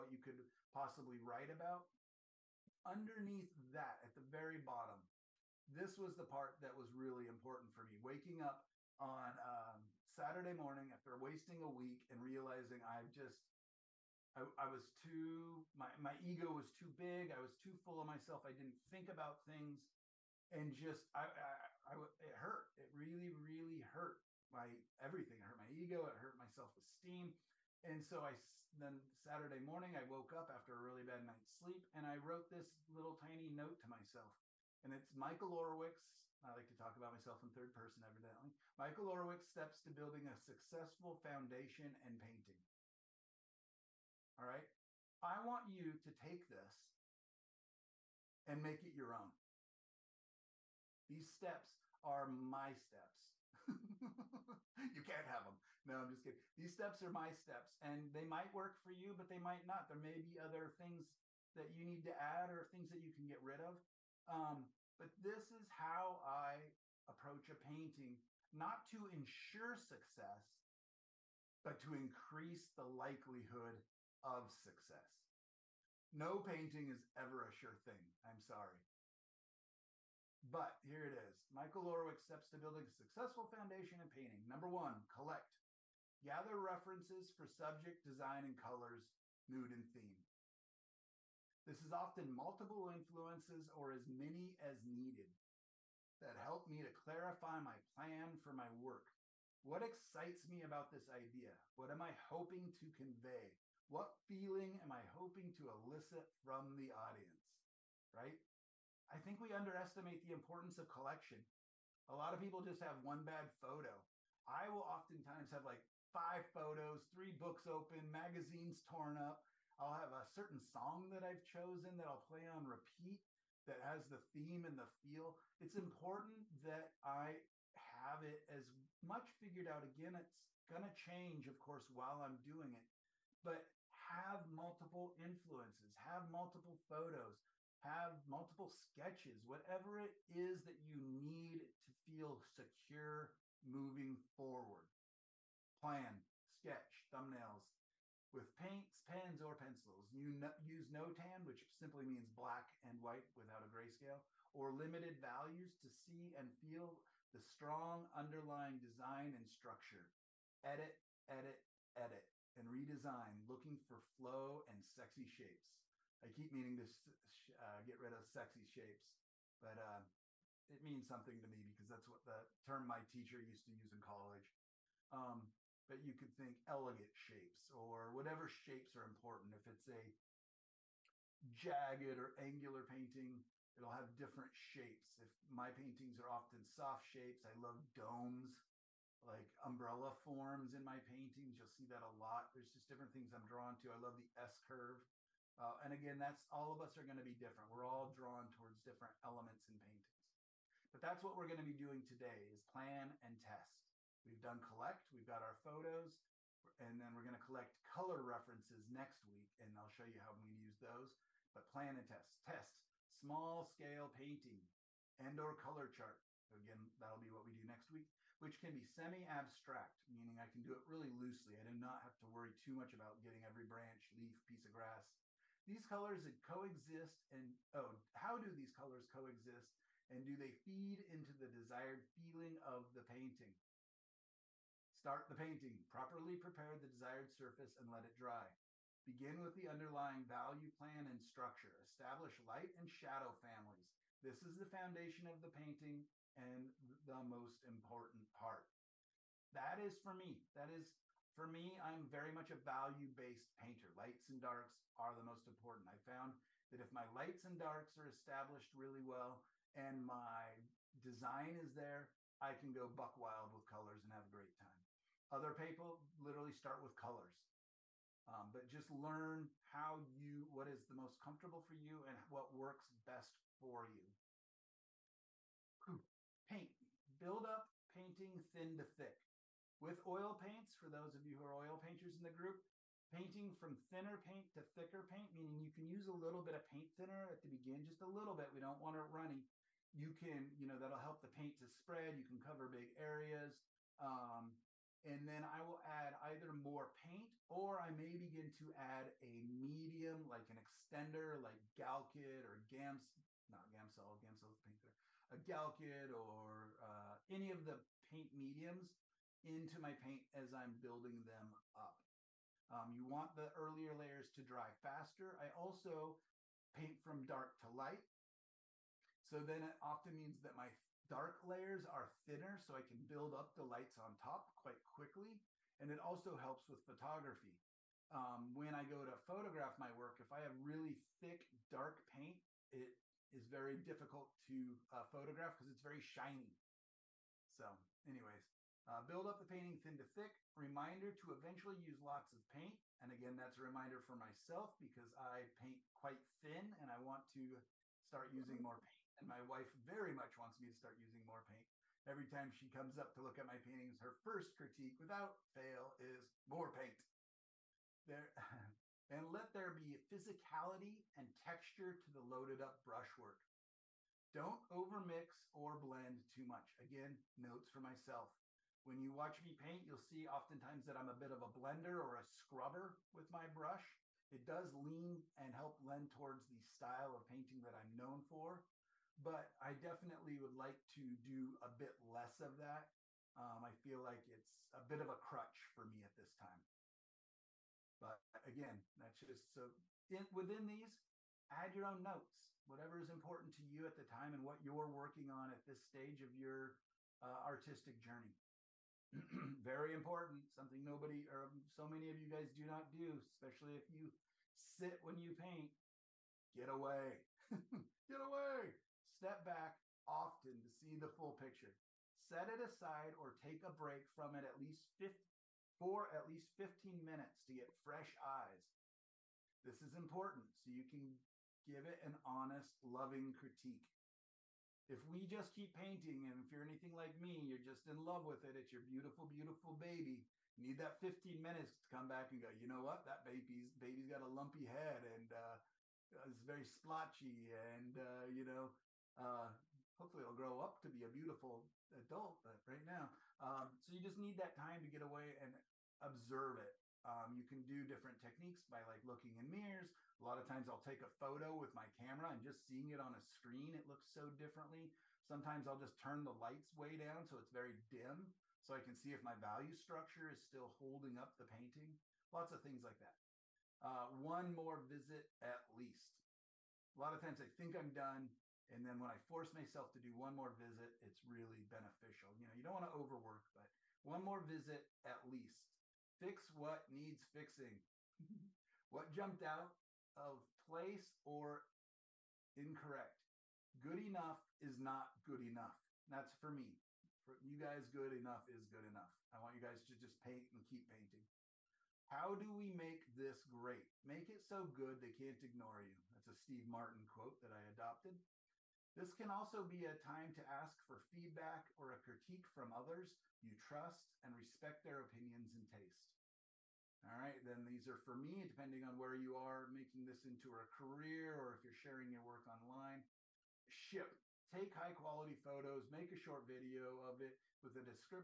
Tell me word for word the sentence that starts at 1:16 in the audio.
No painting is ever a sure thing.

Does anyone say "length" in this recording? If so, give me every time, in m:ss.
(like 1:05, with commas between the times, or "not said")
not said.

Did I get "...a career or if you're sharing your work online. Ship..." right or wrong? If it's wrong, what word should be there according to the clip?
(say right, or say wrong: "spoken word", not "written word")
right.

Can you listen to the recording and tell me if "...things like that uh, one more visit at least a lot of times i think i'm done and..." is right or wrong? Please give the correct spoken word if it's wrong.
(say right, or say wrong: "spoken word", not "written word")
right.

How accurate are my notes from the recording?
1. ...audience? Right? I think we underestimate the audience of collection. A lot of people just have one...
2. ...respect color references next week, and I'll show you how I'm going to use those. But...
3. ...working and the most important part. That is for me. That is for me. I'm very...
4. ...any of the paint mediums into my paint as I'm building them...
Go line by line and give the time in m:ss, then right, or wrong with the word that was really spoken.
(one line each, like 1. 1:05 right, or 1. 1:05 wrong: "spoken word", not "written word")
1. 1:46 wrong: "importance", not "audience"
2. 3:27 wrong: "collect", not "respect"
3. 4:05 wrong: "painting", not "working"
4. 5:07 right.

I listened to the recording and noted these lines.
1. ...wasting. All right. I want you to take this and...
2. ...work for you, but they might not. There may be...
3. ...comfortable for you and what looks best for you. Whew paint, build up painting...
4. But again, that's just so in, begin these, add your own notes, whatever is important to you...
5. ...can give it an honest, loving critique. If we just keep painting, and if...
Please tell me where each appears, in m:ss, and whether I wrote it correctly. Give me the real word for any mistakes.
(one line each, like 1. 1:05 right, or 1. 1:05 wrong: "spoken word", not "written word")
1. 0:42 wrong: "painting", not "wasting"
2. 0:58 right
3. 4:31 wrong: "works", not "looks"
4. 6:27 wrong: "within", not "begin"
5. 7:00 right.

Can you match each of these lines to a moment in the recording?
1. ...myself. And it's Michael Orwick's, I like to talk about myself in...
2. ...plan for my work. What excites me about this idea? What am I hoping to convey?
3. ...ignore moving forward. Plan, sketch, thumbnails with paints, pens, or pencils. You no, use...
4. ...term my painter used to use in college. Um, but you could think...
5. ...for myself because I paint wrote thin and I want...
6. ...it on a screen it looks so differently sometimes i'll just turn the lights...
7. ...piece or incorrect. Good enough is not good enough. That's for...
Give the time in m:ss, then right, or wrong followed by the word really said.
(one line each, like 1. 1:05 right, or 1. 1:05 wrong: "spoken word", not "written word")
1. 0:33 right
2. 1:37 right
3. 2:22 wrong: "secure", not "ignore"
4. 2:52 wrong: "teacher", not "painter"
5. 5:44 wrong: "quite", not "wrote"
6. 7:32 right
7. 8:00 wrong: "place", not "piece".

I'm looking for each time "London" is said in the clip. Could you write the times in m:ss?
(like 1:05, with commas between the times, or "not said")
not said.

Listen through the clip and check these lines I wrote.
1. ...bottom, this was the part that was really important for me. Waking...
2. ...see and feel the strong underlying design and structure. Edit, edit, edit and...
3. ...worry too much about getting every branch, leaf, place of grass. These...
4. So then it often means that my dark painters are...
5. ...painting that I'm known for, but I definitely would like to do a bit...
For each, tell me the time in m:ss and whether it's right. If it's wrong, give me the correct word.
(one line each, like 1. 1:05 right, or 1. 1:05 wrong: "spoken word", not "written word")
1. 0:04 right
2. 2:35 right
3. 3:42 wrong: "piece", not "place"
4. 5:19 wrong: "layers", not "painters"
5. 6:17 right.